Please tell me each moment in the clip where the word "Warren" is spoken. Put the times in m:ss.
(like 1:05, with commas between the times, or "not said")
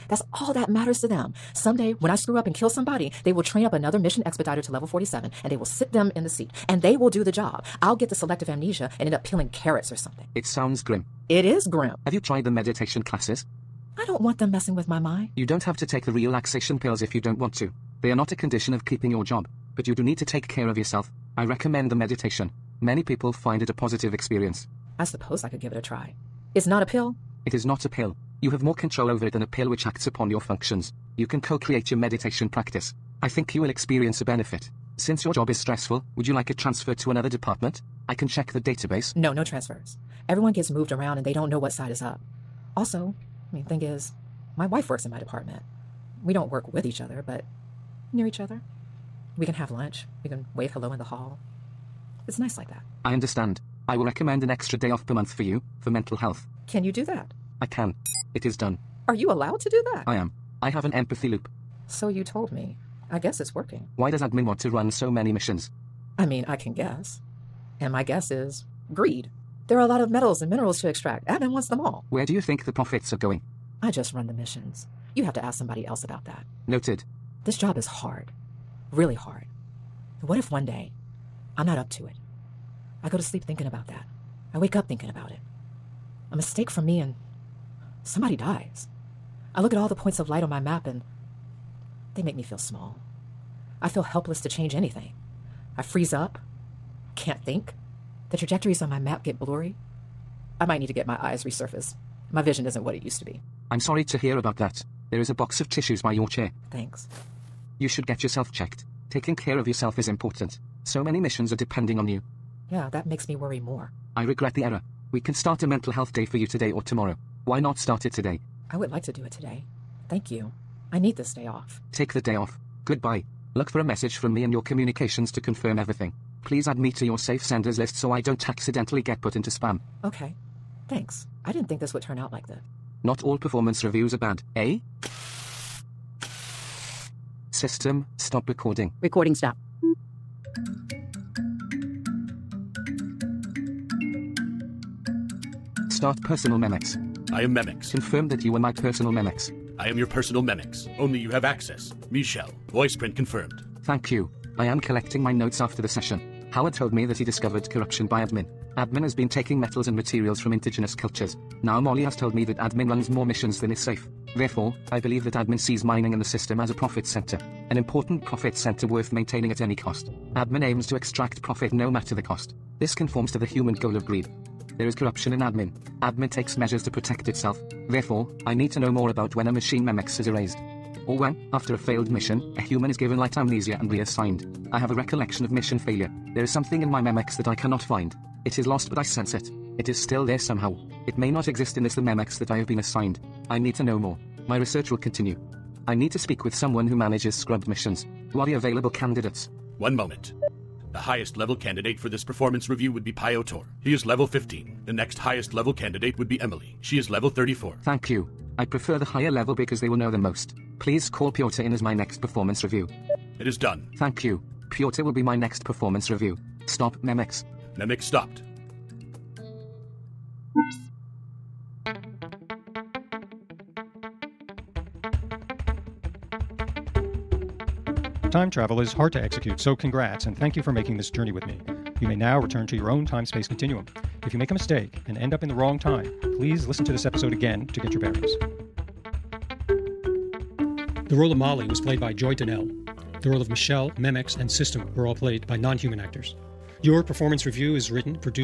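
not said.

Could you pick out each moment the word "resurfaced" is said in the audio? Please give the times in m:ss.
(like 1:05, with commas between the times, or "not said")
1:41.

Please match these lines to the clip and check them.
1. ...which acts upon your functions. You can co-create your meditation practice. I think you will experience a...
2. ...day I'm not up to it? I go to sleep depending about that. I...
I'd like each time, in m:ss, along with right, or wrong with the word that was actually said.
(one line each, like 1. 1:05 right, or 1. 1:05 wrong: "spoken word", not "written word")
1. 0:29 right
2. 1:20 wrong: "thinking", not "depending".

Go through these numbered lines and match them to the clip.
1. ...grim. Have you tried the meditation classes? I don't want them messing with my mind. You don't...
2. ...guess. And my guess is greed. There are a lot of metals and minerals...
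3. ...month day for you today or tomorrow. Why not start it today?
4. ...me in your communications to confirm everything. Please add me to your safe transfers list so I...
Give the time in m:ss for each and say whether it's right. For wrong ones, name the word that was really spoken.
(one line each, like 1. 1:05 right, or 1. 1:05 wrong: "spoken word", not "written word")
1. 0:11 right
2. 1:06 right
3. 1:55 wrong: "health", not "month"
4. 2:04 wrong: "senders", not "transfers".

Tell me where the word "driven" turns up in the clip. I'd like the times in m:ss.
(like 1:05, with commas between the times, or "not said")
not said.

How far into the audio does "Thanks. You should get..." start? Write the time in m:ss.
1:46.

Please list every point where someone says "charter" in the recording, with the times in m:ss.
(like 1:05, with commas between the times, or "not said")
not said.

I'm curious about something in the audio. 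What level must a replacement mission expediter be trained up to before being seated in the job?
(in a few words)
47.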